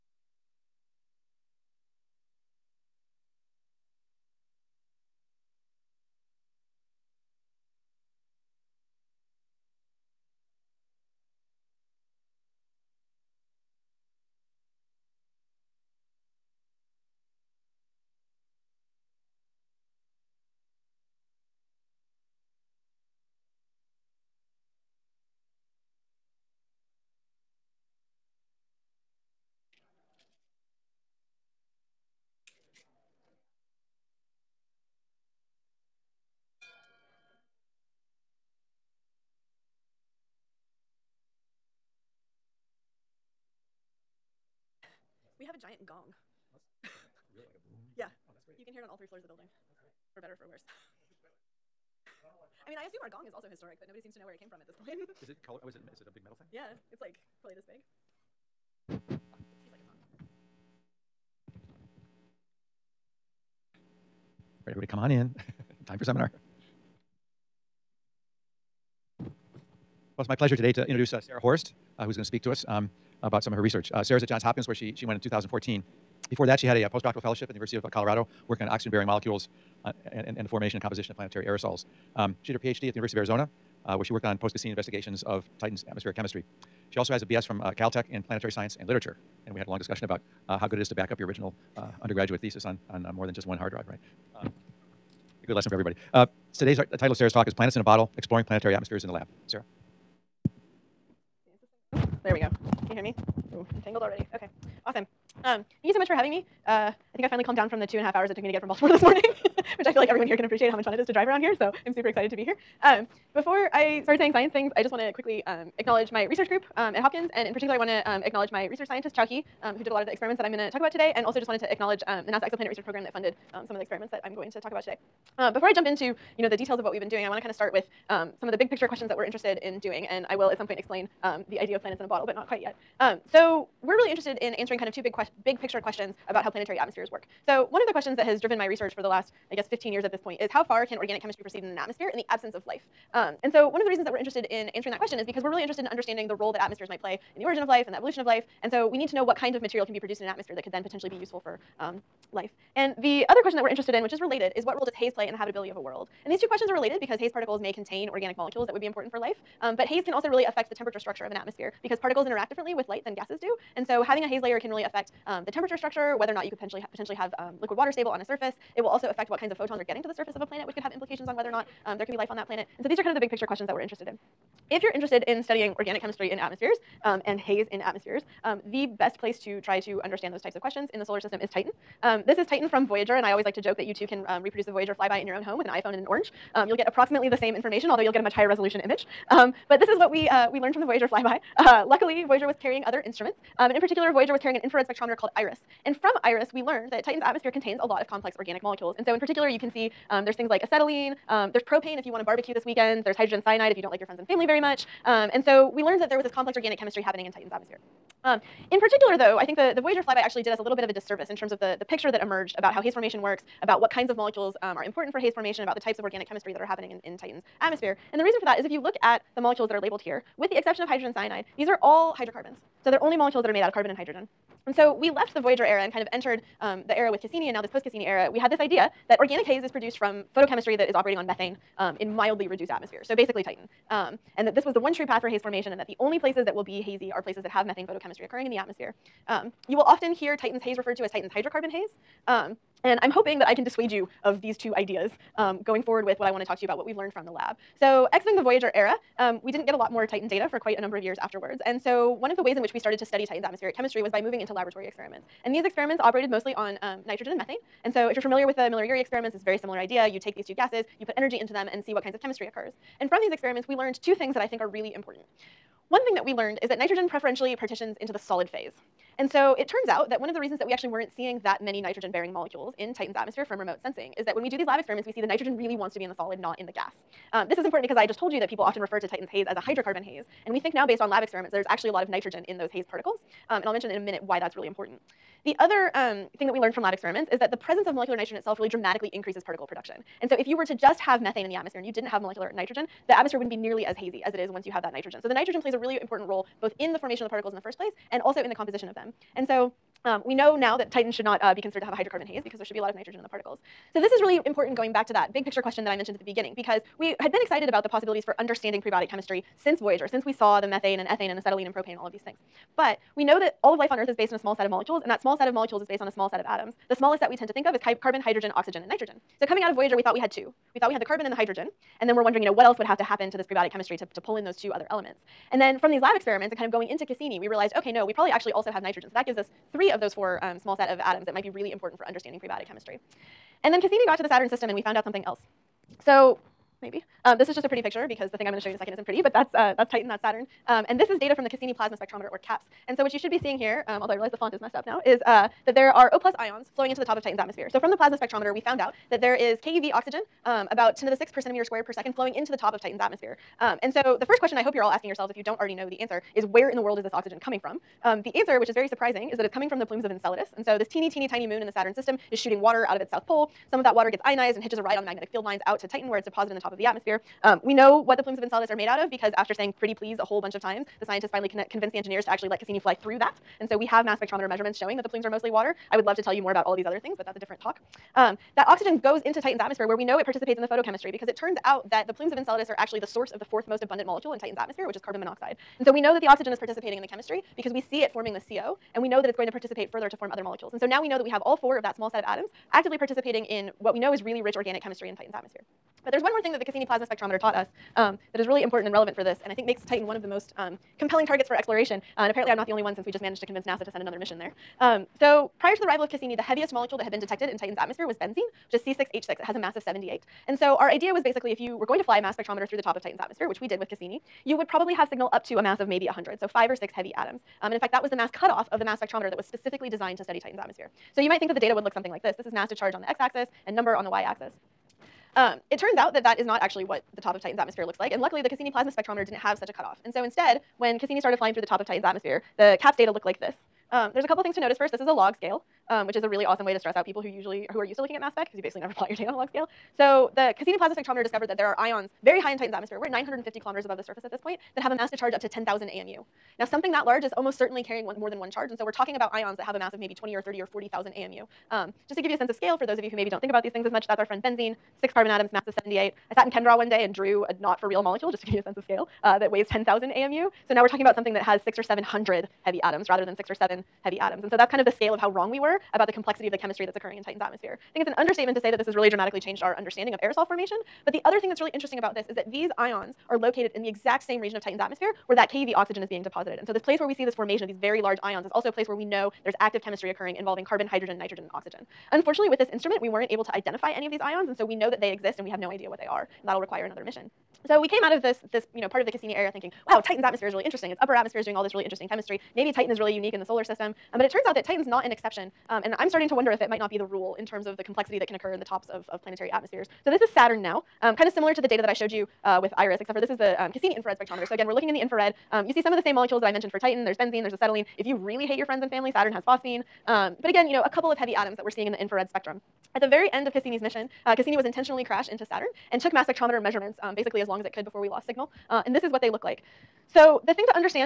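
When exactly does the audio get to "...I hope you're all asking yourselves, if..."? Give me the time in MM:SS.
05:54.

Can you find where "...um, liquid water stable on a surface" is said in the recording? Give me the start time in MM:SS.
02:47.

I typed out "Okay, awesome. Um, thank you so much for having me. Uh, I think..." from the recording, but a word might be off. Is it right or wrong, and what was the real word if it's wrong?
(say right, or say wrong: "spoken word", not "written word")
right.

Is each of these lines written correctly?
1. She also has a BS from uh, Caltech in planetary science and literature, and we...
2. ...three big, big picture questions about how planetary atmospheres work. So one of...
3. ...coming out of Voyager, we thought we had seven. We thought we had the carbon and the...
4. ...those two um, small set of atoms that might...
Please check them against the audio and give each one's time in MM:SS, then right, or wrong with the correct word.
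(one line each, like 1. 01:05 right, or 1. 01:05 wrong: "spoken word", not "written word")
1. 01:26 right
2. 02:14 wrong: "two", not "three"
3. 05:19 wrong: "two", not "seven"
4. 05:30 wrong: "four", not "two".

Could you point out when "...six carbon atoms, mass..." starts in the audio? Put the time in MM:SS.
07:35.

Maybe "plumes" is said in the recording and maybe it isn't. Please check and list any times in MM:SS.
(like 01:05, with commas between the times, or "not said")
05:59, 06:08, 06:15, 06:22.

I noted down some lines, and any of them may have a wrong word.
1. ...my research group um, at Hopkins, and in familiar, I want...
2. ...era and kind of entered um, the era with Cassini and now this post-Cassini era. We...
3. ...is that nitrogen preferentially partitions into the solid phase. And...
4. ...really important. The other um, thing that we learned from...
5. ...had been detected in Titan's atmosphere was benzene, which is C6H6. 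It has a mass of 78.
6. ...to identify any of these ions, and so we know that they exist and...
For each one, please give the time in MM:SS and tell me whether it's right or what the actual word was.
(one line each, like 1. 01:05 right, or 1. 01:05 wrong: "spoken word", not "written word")
1. 01:56 wrong: "particular", not "familiar"
2. 03:45 right
3. 04:26 right
4. 04:44 right
5. 06:47 right
6. 08:03 right.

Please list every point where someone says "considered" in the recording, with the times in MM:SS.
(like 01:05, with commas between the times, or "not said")
05:01.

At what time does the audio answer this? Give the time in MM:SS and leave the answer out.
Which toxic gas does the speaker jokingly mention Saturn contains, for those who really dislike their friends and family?
08:29.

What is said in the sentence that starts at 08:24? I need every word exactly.
So again, we're looking in the infrared.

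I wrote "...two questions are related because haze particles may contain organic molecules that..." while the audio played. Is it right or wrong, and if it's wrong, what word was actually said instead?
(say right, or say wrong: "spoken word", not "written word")
right.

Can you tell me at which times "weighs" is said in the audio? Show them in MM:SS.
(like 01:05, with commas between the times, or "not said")
07:39.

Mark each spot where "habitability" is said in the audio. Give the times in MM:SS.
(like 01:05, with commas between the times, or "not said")
02:35.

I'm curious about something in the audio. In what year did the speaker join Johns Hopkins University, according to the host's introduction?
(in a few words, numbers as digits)
2014.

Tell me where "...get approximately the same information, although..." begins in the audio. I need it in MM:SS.
03:06.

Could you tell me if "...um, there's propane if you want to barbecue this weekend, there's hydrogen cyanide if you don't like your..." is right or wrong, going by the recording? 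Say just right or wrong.
right.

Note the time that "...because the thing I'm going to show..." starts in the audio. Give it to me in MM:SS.
05:38.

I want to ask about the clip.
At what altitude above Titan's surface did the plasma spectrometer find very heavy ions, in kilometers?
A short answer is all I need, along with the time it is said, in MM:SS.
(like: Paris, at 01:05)
950 km, at 07:23.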